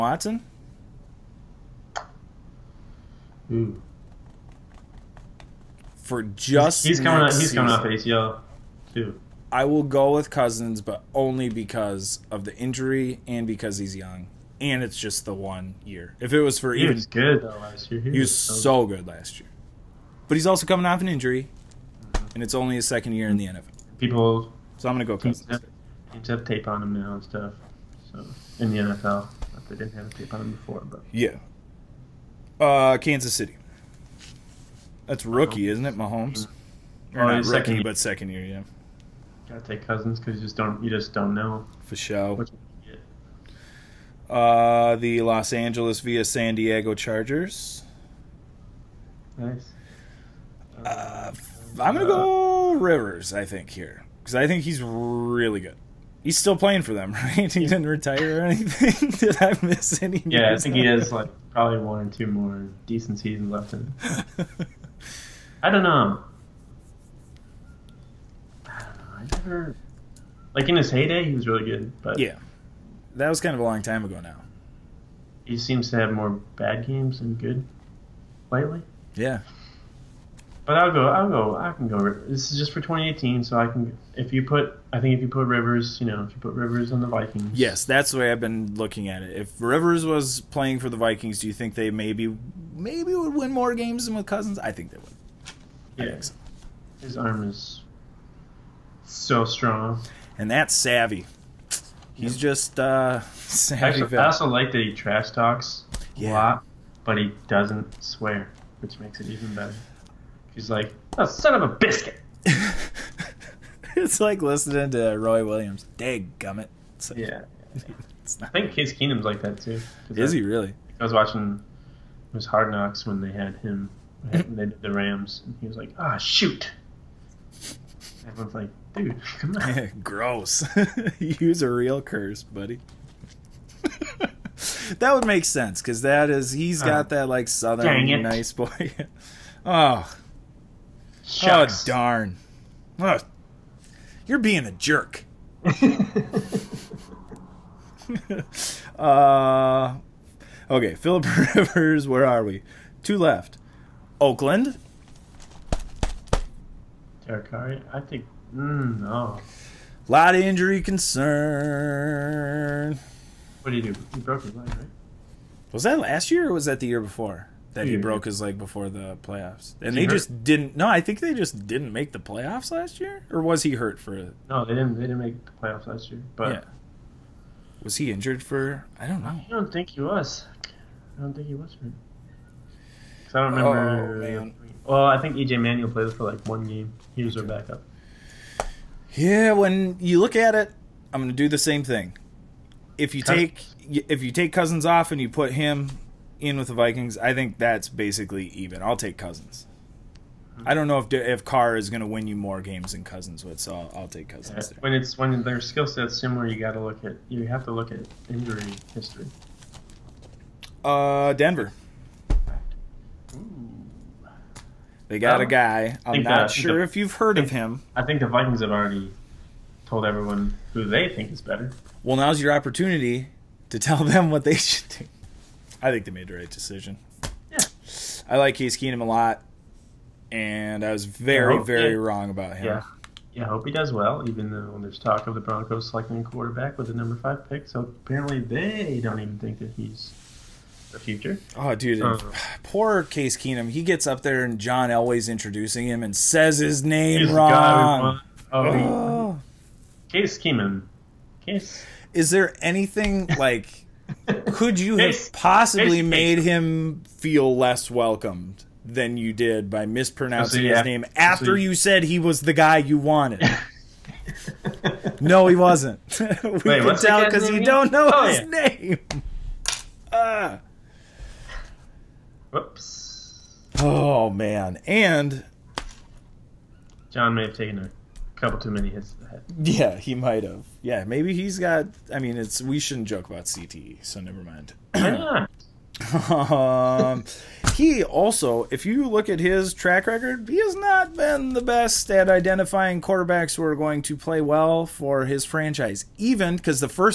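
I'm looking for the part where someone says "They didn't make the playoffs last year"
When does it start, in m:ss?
2:54.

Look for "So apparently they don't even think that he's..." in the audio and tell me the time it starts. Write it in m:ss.
3:57.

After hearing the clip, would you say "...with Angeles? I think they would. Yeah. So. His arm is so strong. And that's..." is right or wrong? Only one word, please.
wrong.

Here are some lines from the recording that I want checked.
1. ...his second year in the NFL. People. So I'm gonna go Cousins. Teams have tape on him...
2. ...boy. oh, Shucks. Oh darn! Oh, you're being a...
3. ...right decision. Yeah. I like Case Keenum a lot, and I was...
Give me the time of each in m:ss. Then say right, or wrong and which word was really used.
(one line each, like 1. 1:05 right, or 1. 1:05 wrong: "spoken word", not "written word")
1. 0:22 right
2. 2:18 right
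3. 3:46 right.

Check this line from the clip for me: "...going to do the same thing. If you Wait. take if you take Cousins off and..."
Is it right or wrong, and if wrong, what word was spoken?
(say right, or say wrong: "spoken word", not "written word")
wrong: "Cousins", not "Wait".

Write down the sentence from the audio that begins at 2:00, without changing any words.
I was watching it was Hard Knocks when they had him they did the Rams and he was like, Ah oh, shoot.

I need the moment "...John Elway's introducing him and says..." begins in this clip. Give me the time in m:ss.
4:04.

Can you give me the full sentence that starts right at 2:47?
that he broke his leg before the playoffs.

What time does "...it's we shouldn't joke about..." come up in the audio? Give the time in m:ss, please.
4:42.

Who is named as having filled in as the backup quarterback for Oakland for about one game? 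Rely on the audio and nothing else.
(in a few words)
EJ Manuel.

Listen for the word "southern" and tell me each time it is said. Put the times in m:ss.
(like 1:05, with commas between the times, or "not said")
2:17.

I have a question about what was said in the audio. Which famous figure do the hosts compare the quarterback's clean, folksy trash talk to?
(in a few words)
Roy Williams.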